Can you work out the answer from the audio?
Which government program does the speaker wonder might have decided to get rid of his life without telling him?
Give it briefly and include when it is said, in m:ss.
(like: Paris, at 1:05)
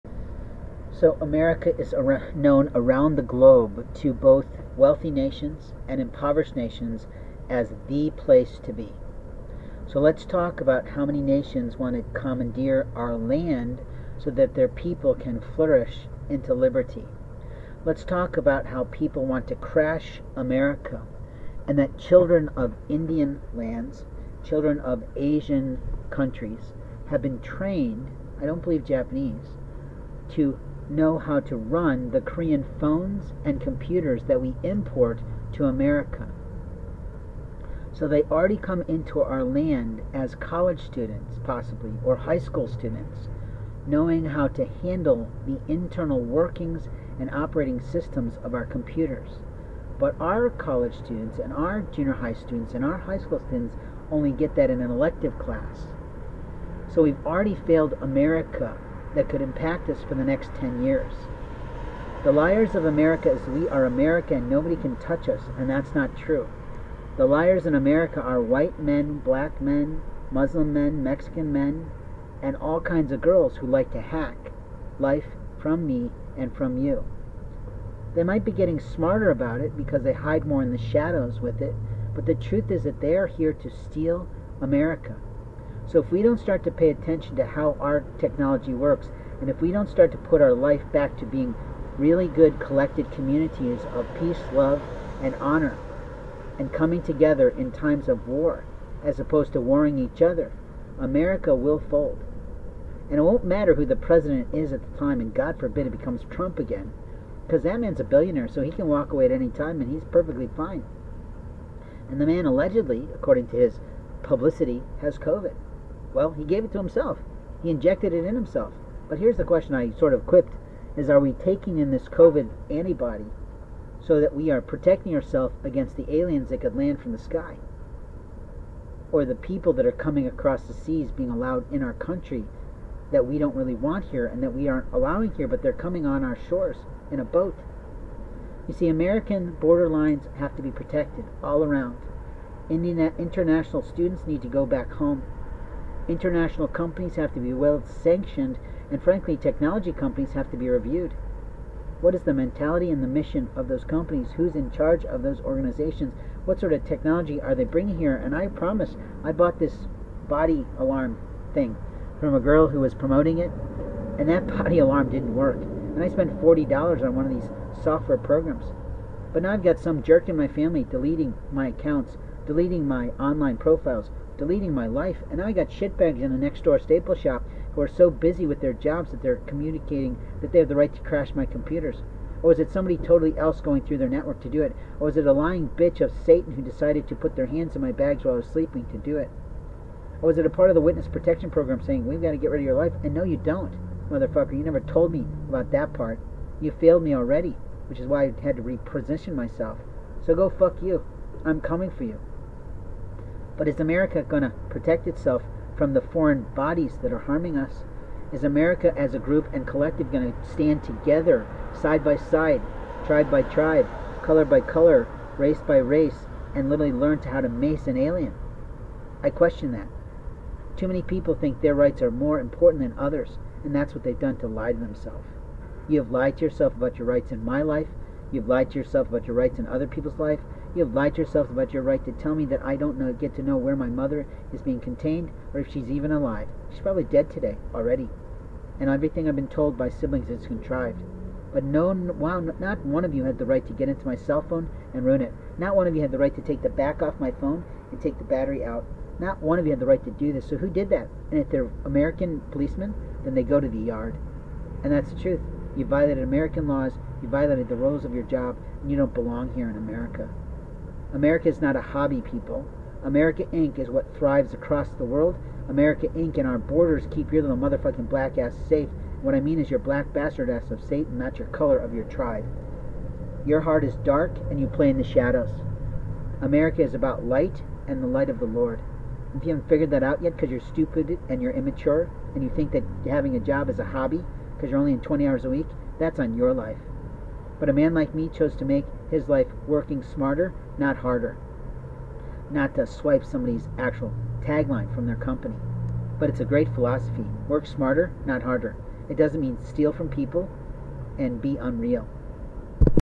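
witness protection program, at 3:10.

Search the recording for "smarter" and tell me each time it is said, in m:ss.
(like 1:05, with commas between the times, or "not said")
1:18, 4:50, 4:57.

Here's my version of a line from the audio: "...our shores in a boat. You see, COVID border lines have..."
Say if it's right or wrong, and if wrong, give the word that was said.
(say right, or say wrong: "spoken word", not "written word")
wrong: "American", not "COVID".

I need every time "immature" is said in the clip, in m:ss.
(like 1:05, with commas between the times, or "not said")
4:41.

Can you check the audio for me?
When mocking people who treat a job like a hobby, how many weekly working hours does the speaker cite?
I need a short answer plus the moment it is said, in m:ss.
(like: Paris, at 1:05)
20 hours, at 4:45.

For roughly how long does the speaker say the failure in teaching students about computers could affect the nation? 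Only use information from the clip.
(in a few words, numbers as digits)
10 years.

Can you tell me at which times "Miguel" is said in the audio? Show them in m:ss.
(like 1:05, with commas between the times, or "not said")
not said.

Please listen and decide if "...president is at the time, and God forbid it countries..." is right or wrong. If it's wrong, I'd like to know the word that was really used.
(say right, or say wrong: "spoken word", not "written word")
wrong: "becomes", not "countries".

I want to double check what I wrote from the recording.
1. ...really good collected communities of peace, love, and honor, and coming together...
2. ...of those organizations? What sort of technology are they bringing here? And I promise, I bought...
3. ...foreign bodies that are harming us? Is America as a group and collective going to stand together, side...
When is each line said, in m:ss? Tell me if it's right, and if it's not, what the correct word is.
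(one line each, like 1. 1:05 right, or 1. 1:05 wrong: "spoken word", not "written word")
1. 1:31 right
2. 2:35 right
3. 3:26 right.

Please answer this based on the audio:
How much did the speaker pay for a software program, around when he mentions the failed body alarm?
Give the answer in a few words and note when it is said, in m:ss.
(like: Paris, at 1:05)
$40, at 2:46.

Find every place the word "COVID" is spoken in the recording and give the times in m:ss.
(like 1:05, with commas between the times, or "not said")
1:55, 2:02.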